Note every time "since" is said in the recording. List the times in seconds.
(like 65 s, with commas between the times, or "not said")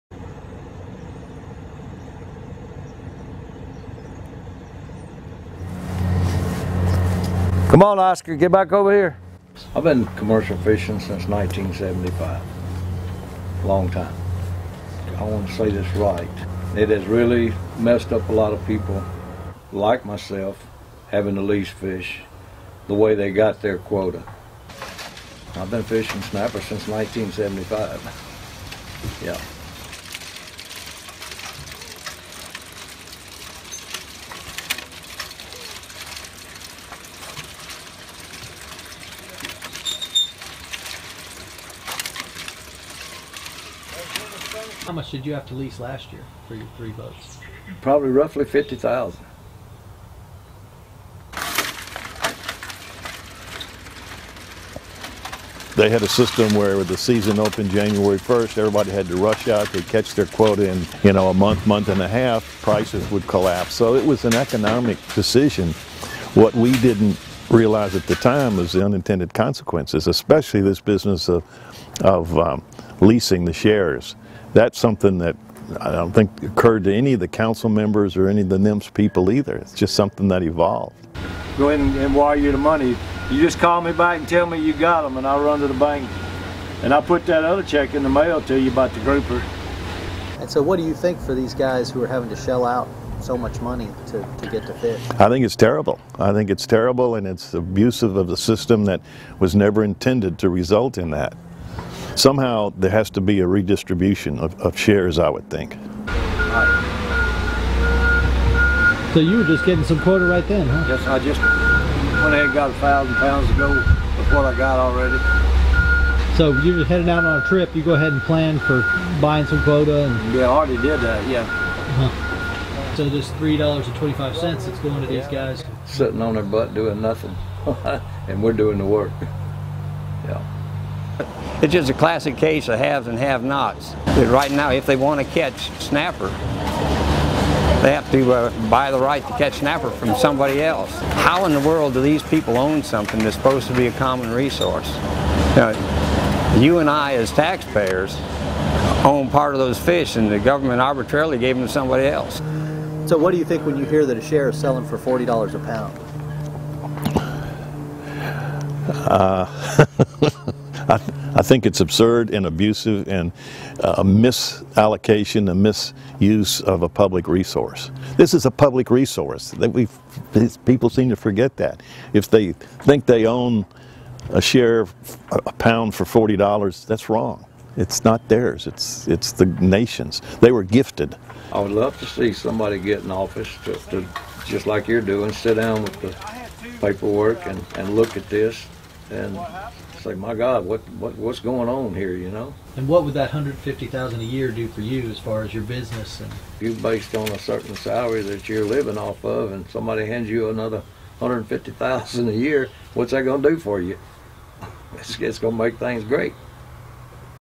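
10 s, 26 s.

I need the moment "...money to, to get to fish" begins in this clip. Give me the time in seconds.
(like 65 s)
93 s.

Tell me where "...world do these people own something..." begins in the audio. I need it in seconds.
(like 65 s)
141 s.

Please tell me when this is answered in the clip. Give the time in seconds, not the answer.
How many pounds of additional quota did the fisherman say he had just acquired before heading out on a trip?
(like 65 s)
112 s.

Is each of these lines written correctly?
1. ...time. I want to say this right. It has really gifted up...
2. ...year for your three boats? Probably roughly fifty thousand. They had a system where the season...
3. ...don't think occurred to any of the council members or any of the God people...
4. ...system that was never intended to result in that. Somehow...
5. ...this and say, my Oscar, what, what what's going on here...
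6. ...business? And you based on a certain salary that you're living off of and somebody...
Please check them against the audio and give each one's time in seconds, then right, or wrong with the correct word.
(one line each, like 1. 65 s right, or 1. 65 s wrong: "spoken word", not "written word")
1. 13 s wrong: "messed", not "gifted"
2. 46 s right
3. 75 s wrong: "NMFS", not "God"
4. 98 s right
5. 188 s wrong: "God", not "Oscar"
6. 195 s right.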